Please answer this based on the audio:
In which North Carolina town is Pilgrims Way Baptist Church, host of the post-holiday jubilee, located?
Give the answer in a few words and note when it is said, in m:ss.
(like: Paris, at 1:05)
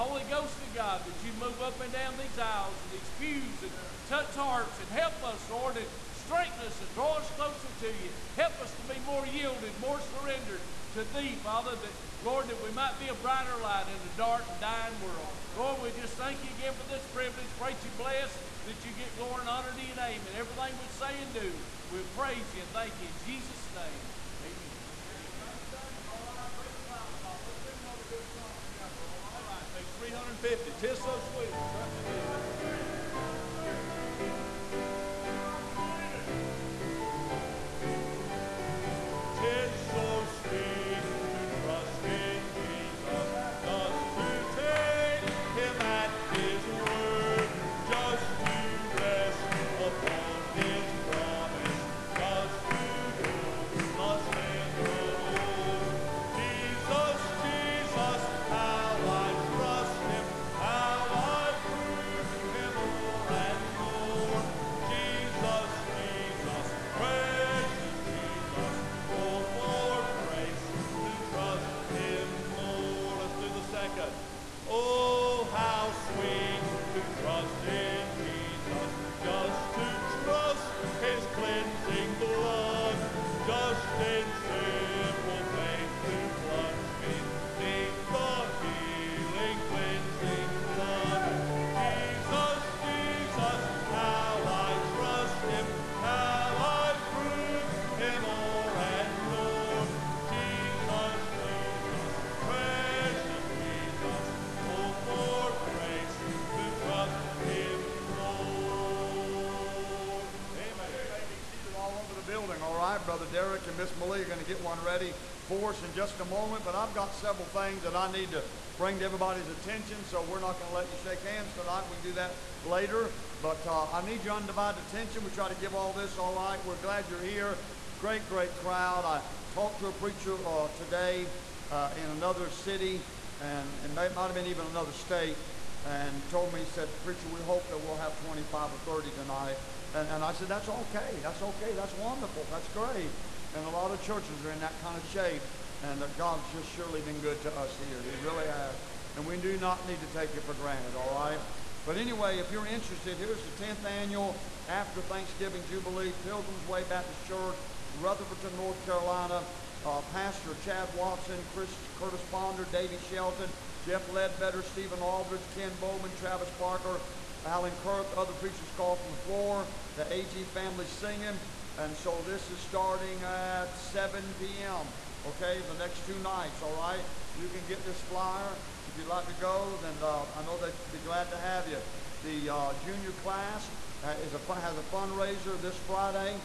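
Rutherford, at 2:37.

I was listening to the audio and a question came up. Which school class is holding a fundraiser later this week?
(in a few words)
junior class.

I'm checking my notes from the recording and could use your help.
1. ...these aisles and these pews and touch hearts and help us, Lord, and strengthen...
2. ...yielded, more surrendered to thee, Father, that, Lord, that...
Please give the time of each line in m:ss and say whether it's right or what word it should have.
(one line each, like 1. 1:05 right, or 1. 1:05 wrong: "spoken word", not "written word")
1. 0:02 right
2. 0:09 right.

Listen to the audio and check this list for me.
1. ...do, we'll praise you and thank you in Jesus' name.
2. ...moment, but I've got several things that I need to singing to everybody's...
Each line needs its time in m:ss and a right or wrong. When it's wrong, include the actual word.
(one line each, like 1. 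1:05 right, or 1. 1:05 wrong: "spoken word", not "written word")
1. 0:21 right
2. 1:56 wrong: "bring", not "singing".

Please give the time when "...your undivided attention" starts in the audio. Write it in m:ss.
2:04.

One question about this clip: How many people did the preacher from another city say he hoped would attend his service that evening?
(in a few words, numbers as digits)
25 or 30.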